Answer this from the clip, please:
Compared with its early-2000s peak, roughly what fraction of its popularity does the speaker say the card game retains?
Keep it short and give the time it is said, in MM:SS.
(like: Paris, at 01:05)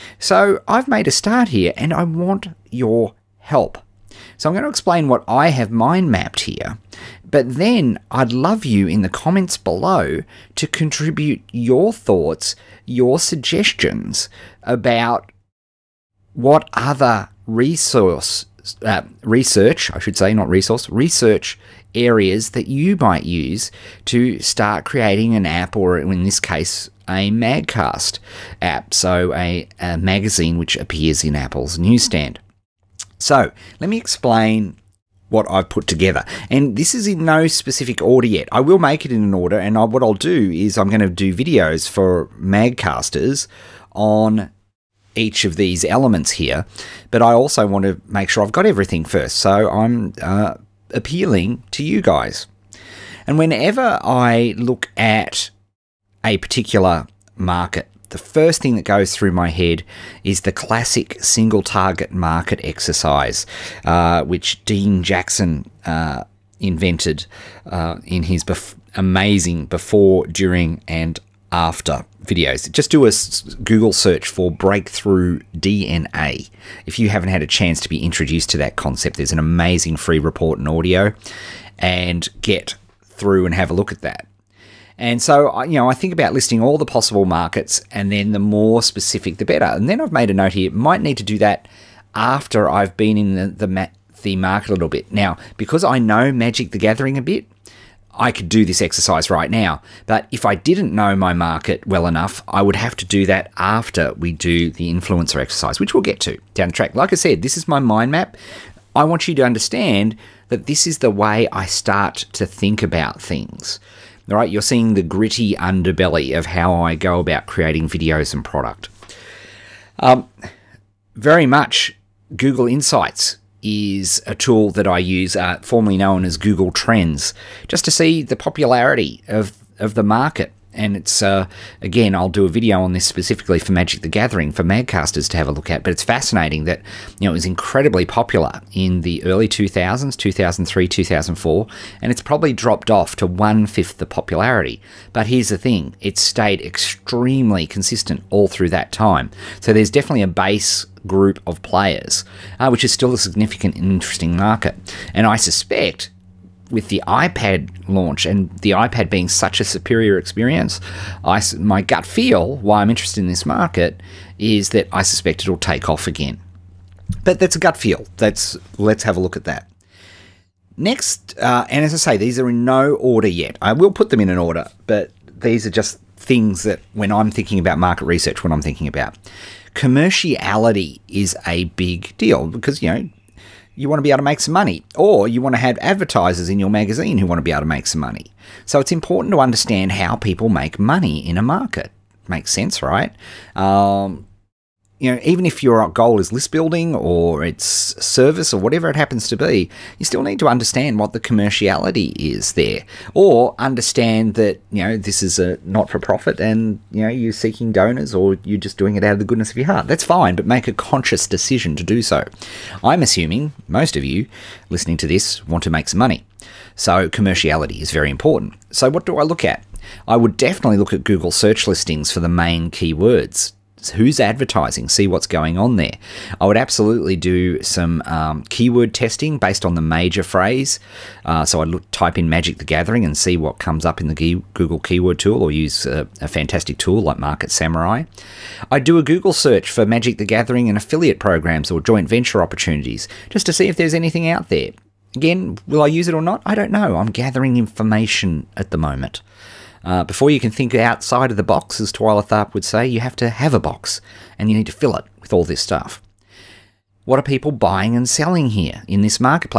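one fifth, at 02:23.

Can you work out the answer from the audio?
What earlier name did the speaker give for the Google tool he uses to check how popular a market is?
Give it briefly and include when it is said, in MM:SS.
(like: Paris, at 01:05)
Google Trends, at 02:06.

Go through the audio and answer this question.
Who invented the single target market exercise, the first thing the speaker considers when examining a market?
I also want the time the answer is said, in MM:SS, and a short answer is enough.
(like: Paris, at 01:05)
Dean Jackson, at 01:04.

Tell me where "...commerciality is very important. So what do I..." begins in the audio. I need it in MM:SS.
03:37.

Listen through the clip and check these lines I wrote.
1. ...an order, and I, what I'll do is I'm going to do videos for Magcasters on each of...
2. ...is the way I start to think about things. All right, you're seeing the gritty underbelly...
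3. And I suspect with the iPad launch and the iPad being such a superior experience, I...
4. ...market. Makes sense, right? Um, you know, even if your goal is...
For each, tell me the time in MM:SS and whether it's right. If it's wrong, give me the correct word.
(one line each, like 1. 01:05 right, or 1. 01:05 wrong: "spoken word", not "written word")
1. 00:39 right
2. 01:50 right
3. 02:35 right
4. 03:11 right.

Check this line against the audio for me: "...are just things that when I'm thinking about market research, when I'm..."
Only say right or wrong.
right.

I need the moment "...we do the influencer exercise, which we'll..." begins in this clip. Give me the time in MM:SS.
01:44.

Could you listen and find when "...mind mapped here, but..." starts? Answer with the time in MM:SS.
00:05.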